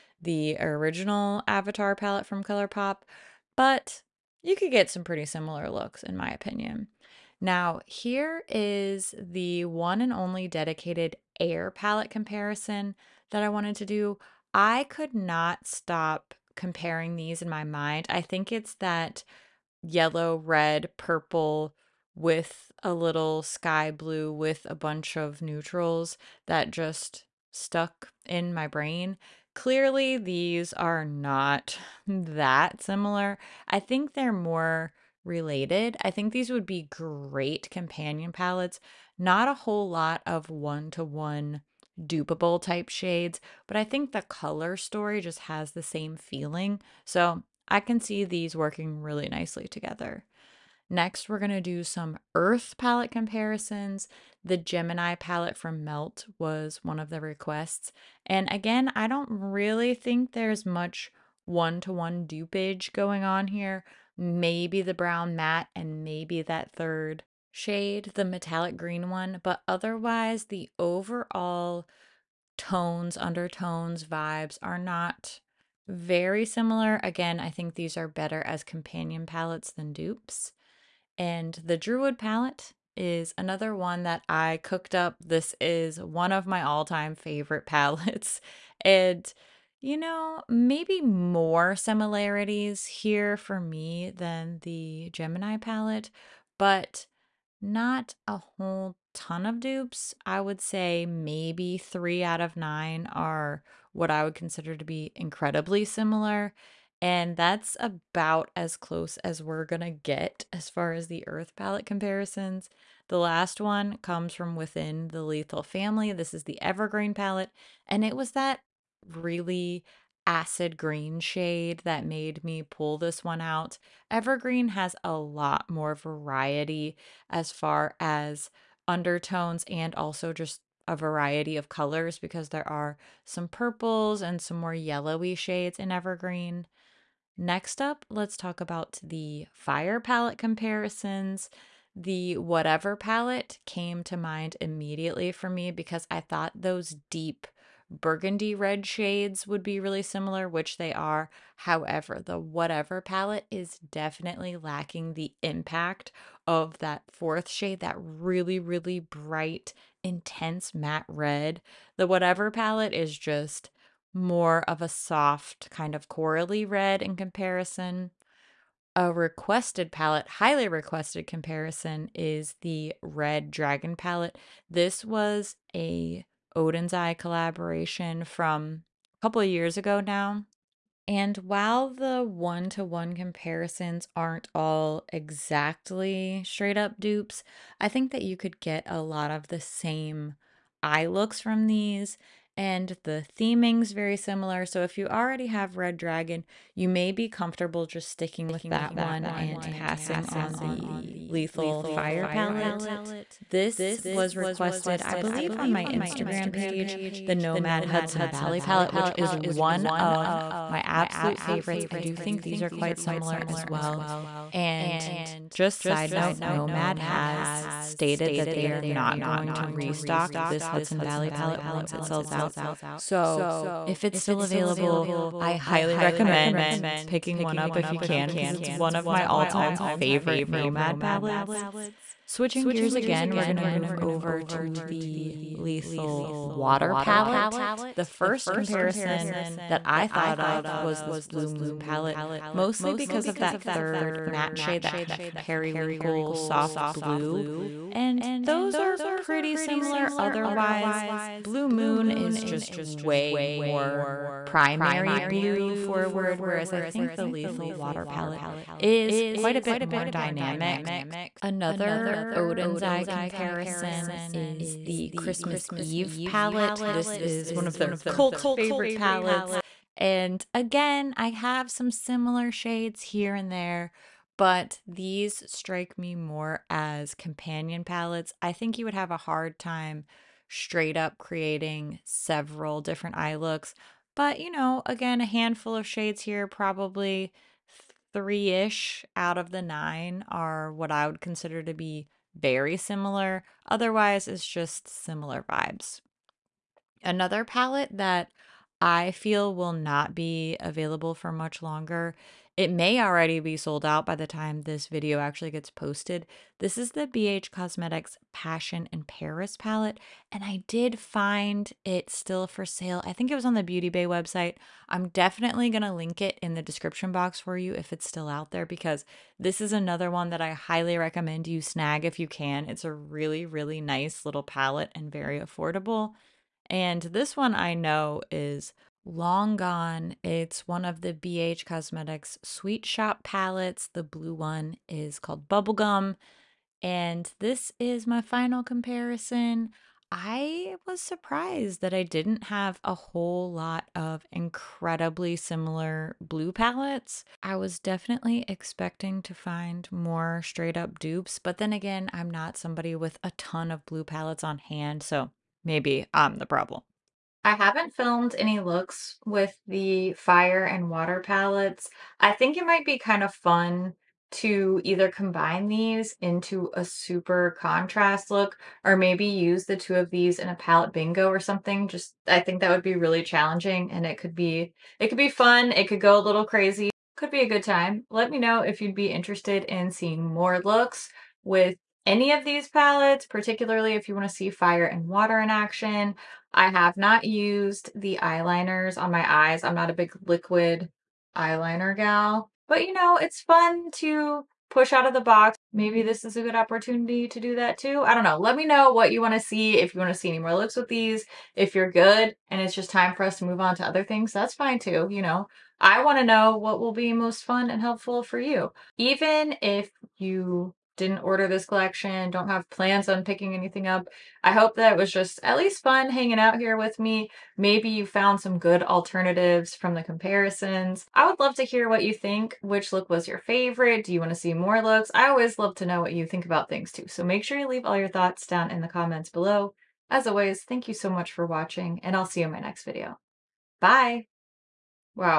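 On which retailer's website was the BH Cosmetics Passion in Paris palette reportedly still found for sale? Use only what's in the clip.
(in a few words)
Beauty Bay.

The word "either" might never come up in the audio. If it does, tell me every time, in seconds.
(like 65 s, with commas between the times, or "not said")
364 s.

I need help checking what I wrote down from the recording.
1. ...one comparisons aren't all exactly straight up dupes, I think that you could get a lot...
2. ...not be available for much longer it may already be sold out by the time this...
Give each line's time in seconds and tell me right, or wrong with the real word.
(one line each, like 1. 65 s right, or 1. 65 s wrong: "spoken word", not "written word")
1. 182 s right
2. 299 s right.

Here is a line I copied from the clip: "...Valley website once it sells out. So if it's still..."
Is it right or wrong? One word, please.
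wrong.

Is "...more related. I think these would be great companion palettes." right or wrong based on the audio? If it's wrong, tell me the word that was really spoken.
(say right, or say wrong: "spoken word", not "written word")
right.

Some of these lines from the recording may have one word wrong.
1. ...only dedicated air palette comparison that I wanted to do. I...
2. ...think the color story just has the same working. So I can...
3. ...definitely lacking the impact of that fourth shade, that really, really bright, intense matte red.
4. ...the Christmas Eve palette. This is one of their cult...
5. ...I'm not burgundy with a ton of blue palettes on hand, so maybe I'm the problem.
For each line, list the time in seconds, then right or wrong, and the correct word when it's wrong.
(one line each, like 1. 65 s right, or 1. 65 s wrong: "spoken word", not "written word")
1. 10 s right
2. 43 s wrong: "feeling", not "working"
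3. 153 s right
4. 264 s right
5. 352 s wrong: "somebody", not "burgundy".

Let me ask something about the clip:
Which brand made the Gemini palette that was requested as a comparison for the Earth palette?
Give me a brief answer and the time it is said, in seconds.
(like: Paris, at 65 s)
Melt, at 55 s.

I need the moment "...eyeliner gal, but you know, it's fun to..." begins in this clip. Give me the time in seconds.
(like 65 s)
391 s.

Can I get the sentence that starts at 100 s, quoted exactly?
I would say maybe three out of nine are what I would consider to be incredibly similar.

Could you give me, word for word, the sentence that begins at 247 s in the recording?
And those are pretty similar otherwise.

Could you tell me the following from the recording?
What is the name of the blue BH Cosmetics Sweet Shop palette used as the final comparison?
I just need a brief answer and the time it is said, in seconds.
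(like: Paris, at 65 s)
Bubblegum, at 335 s.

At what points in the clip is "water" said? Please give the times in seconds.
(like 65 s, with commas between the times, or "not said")
236 s, 257 s, 360 s, 385 s.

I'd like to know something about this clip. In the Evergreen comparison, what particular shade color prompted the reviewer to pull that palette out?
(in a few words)
acid green.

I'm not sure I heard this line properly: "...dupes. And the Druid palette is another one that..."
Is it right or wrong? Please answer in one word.
right.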